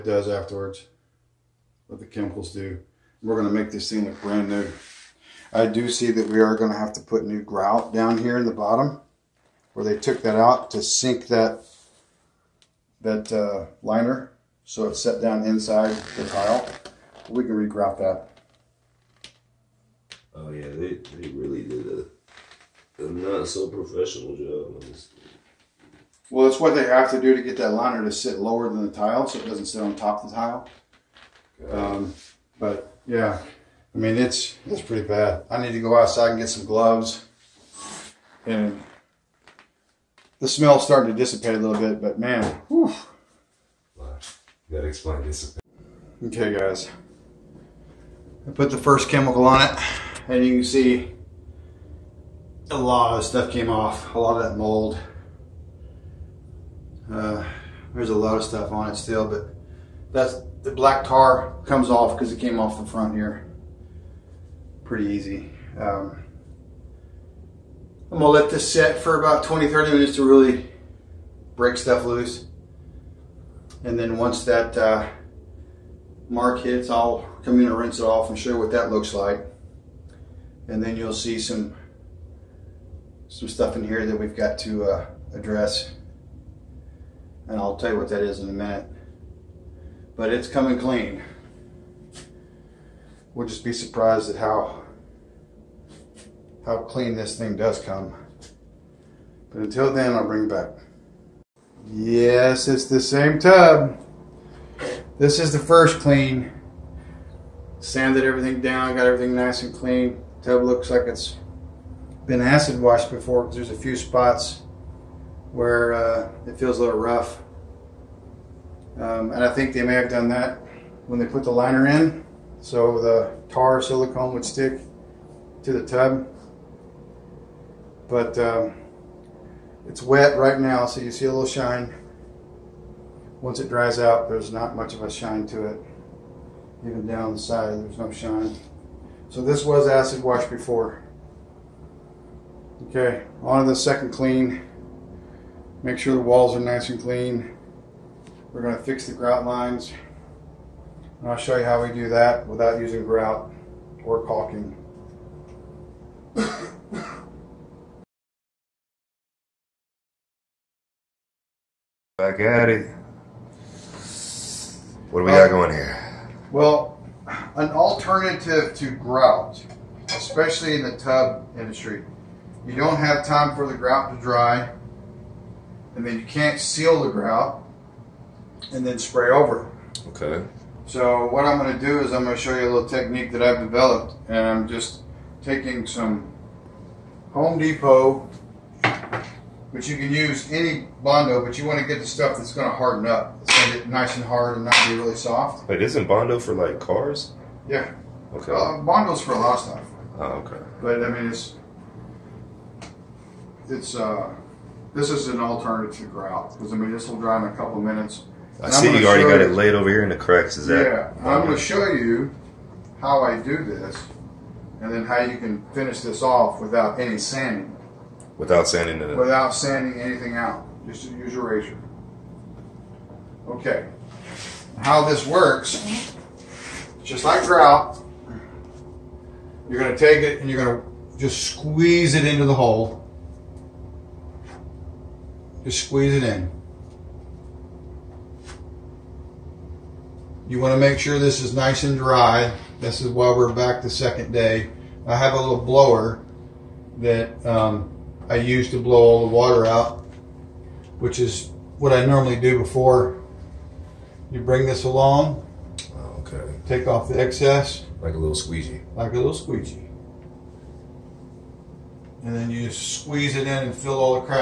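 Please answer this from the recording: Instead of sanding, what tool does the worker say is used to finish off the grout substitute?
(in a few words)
A razor.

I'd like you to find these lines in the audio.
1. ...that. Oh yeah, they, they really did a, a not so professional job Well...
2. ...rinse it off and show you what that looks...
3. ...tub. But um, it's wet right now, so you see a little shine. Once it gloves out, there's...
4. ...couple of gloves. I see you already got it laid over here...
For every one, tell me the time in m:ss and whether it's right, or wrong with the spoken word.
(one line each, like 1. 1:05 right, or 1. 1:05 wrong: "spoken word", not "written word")
1. 0:17 right
2. 1:17 right
3. 2:05 wrong: "dries", not "gloves"
4. 3:27 wrong: "minutes", not "gloves".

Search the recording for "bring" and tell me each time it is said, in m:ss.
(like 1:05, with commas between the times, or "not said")
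1:40, 4:14.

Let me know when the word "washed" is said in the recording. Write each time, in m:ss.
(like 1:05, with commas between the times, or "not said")
1:52, 2:20.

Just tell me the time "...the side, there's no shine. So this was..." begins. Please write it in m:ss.
2:17.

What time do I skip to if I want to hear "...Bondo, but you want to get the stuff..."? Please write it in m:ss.
3:11.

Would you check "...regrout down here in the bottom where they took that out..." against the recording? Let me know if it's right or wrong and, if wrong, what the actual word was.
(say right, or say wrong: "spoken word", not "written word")
wrong: "grout", not "regrout".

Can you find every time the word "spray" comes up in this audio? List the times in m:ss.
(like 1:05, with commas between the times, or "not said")
2:58.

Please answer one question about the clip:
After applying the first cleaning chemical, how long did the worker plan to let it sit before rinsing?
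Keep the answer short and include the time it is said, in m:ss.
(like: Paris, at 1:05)
20 to 30 minutes, at 1:09.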